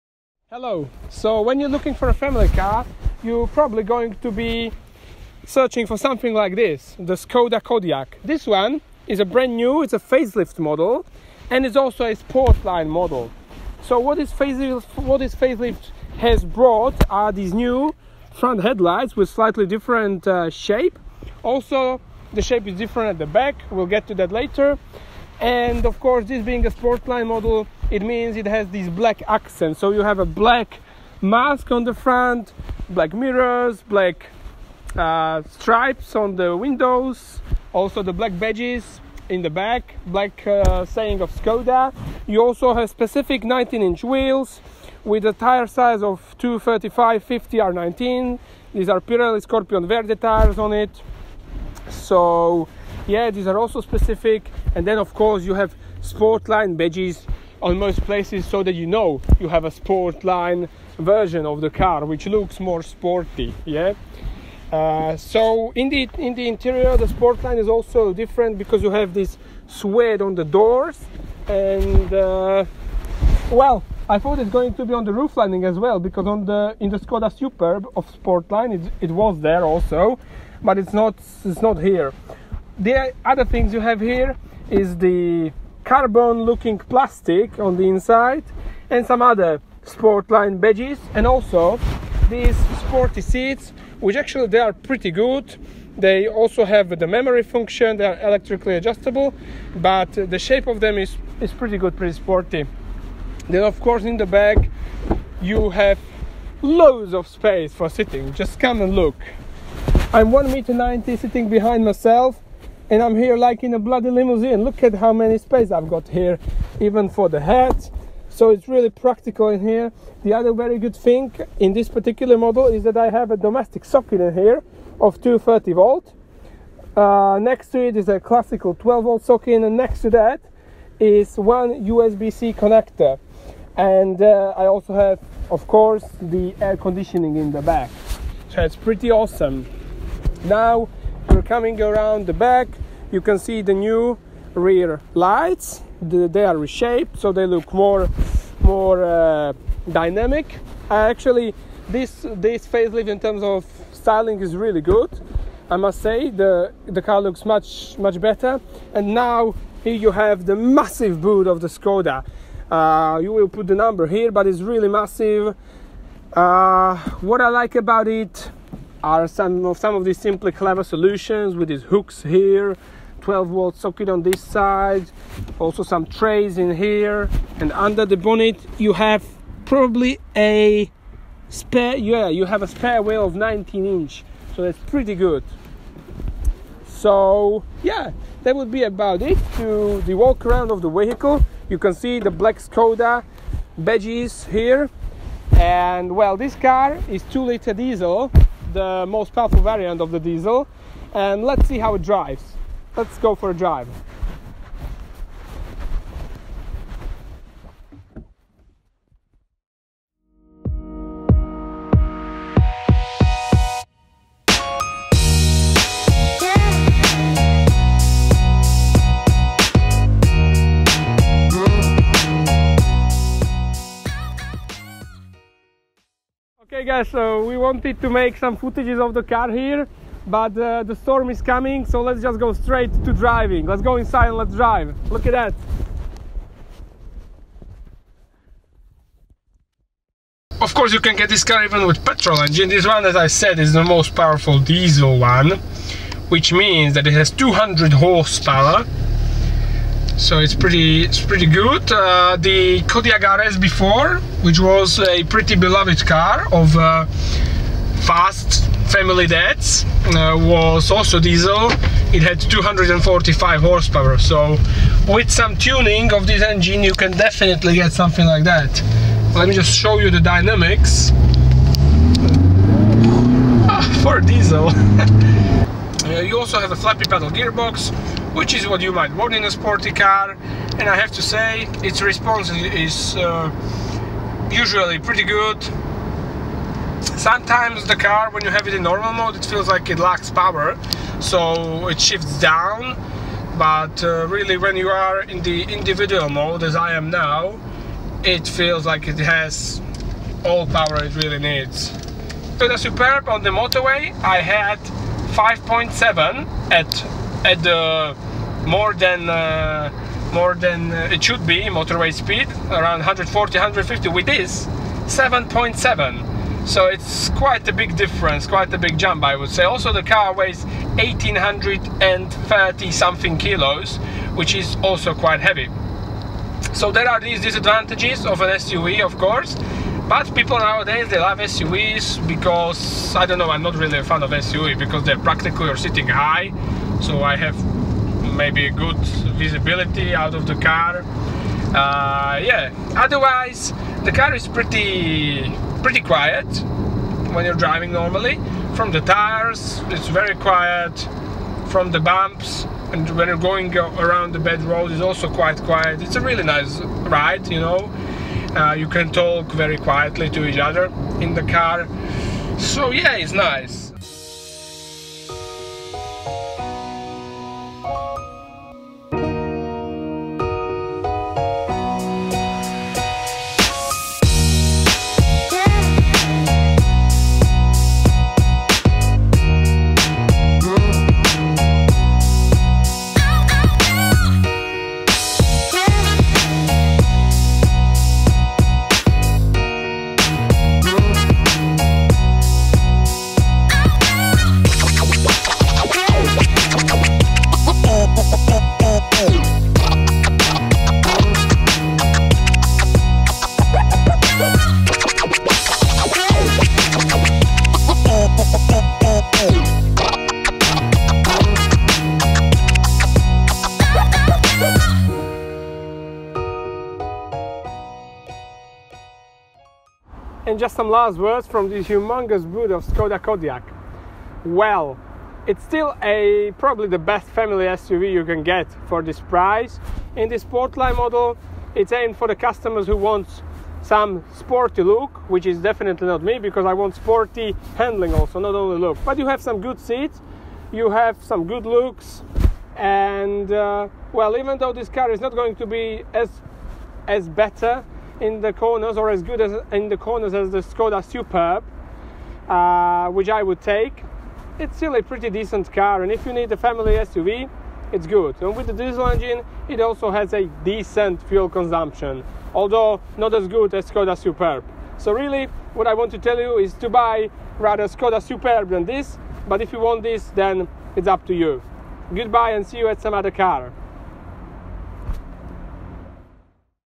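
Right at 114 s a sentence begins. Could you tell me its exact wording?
Look at how many space I've got here, even for the head.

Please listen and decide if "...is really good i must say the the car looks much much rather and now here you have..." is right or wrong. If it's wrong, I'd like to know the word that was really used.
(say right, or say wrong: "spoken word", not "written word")
wrong: "better", not "rather".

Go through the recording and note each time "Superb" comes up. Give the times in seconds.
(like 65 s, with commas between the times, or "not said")
77 s, 302 s, 451 s, 464 s, 468 s.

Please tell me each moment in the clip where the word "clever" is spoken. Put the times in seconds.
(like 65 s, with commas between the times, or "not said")
170 s.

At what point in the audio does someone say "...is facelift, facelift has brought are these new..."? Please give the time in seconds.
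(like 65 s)
14 s.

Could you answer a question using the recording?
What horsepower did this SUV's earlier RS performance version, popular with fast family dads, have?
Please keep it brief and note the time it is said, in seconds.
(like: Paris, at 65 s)
245 horsepower, at 262 s.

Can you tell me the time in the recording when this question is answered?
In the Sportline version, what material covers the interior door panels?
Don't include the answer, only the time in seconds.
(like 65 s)
69 s.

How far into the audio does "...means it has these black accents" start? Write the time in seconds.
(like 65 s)
28 s.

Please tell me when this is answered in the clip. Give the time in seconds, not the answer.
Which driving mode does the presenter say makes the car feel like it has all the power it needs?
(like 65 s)
295 s.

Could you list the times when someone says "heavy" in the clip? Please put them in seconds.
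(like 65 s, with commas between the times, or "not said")
325 s.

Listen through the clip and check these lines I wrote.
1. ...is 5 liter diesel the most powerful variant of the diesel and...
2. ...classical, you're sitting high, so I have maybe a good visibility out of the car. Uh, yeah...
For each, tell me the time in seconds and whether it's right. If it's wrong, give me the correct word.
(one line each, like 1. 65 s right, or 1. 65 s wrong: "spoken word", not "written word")
1. 197 s wrong: "2", not "5"
2. 335 s wrong: "practical", not "classical".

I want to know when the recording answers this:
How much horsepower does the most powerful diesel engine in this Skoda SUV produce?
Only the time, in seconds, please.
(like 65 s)
247 s.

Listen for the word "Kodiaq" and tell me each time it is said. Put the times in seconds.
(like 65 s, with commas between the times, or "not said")
7 s, 252 s, 423 s.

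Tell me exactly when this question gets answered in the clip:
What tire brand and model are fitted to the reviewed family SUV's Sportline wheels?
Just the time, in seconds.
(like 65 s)
49 s.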